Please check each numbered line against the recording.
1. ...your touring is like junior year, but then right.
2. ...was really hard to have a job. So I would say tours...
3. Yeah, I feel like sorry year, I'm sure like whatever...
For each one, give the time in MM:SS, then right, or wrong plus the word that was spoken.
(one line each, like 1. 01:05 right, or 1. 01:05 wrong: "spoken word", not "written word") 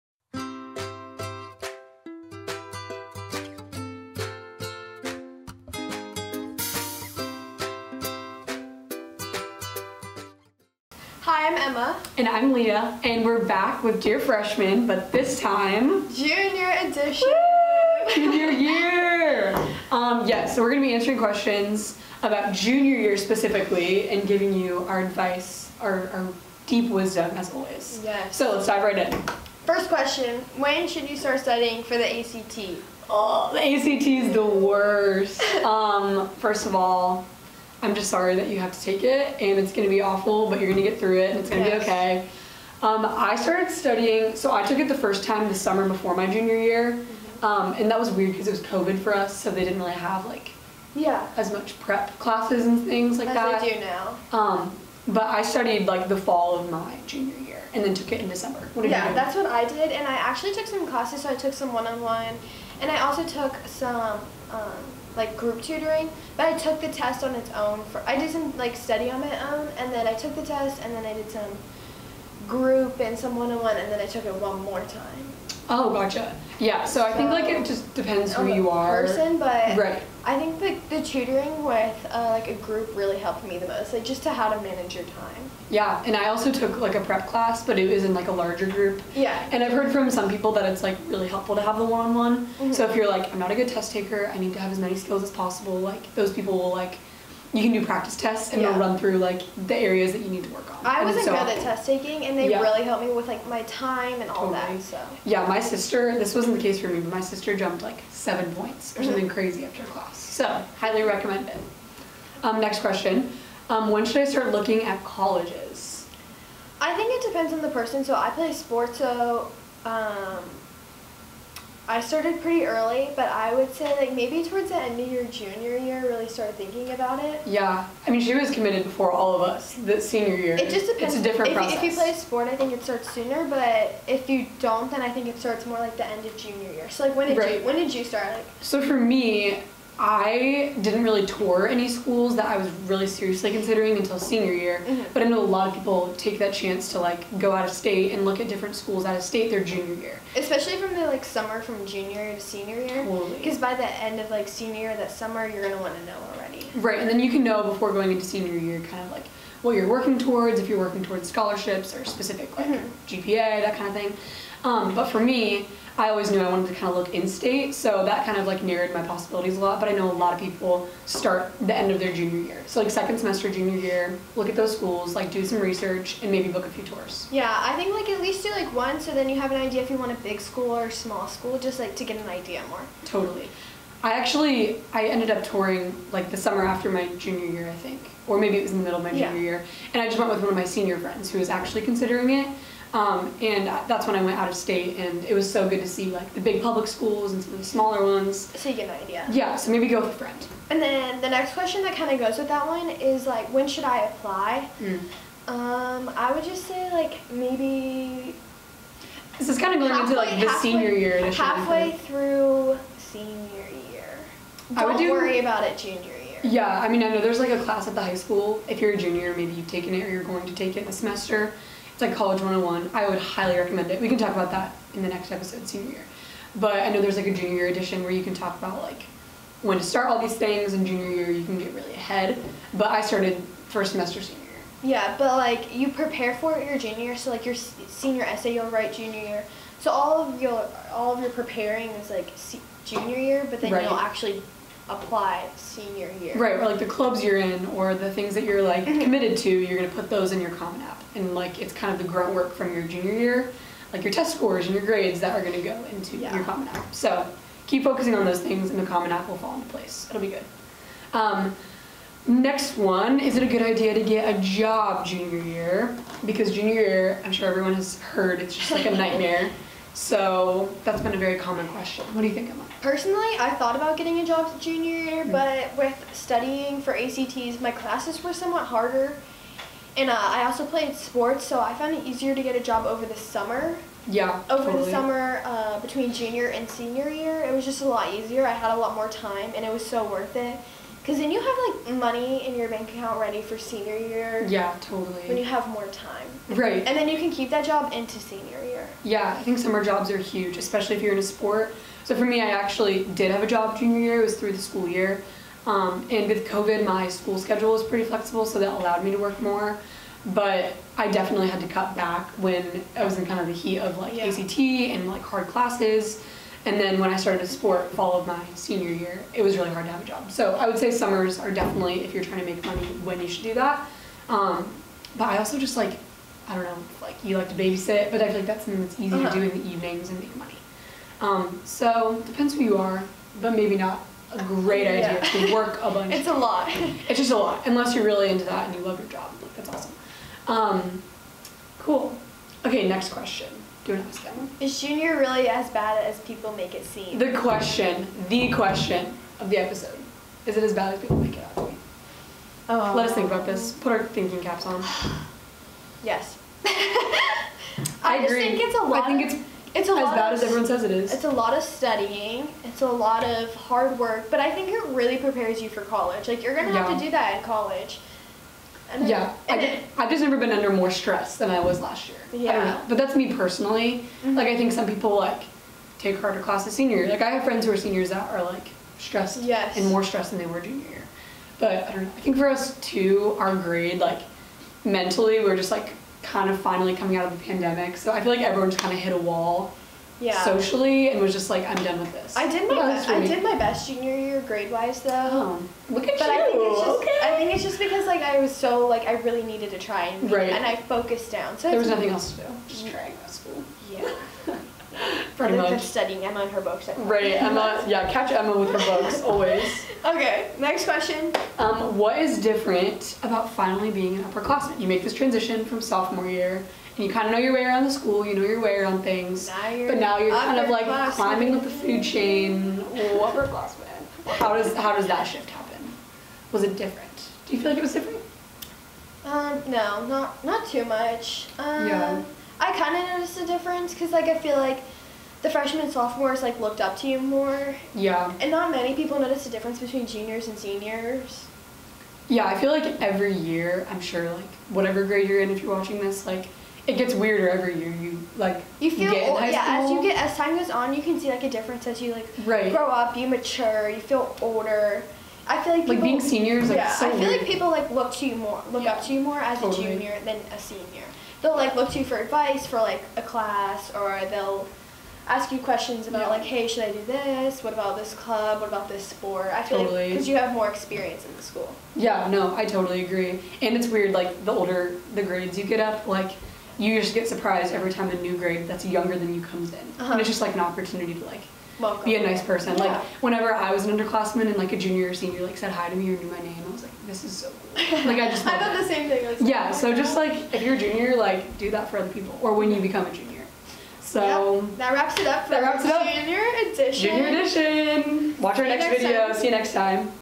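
1. 04:01 wrong: "preparing", not "touring"
2. 05:19 wrong: "summers", not "tours"
3. 07:22 wrong: "every", not "sorry".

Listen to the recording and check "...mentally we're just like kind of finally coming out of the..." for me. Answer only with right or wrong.
right.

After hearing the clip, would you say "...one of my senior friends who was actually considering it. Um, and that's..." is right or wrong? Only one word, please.
right.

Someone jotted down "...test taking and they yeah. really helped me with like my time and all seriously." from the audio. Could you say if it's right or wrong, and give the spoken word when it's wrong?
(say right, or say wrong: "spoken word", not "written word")
wrong: "totally", not "seriously".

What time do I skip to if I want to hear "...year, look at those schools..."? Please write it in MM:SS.
02:53.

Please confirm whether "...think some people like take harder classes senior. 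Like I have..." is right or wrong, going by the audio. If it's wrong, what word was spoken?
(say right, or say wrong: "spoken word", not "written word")
right.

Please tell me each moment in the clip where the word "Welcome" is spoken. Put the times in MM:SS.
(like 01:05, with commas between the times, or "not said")
08:01.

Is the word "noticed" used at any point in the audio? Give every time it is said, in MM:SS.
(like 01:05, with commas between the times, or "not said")
07:13, 07:19.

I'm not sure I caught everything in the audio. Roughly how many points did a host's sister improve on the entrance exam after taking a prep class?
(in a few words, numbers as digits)
7.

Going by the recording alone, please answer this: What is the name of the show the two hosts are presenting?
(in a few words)
Dear Freshman.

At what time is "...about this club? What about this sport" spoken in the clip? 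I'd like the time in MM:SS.
07:47.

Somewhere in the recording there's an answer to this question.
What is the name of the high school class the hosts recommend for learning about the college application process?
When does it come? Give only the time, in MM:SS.
03:42.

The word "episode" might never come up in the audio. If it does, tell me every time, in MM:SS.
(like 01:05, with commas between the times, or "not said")
03:45, 05:49.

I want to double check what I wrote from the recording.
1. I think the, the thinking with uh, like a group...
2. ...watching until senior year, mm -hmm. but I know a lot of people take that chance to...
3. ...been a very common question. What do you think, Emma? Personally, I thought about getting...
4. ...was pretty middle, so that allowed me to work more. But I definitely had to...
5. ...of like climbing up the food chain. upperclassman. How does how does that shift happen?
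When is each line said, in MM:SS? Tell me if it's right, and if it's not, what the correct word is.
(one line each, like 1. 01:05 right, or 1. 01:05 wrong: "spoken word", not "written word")
1. 01:20 wrong: "tutoring", not "thinking"
2. 02:23 wrong: "considering", not "watching"
3. 04:31 right
4. 05:07 wrong: "flexible", not "middle"
5. 07:00 right.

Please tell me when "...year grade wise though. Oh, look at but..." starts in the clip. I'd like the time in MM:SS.
06:34.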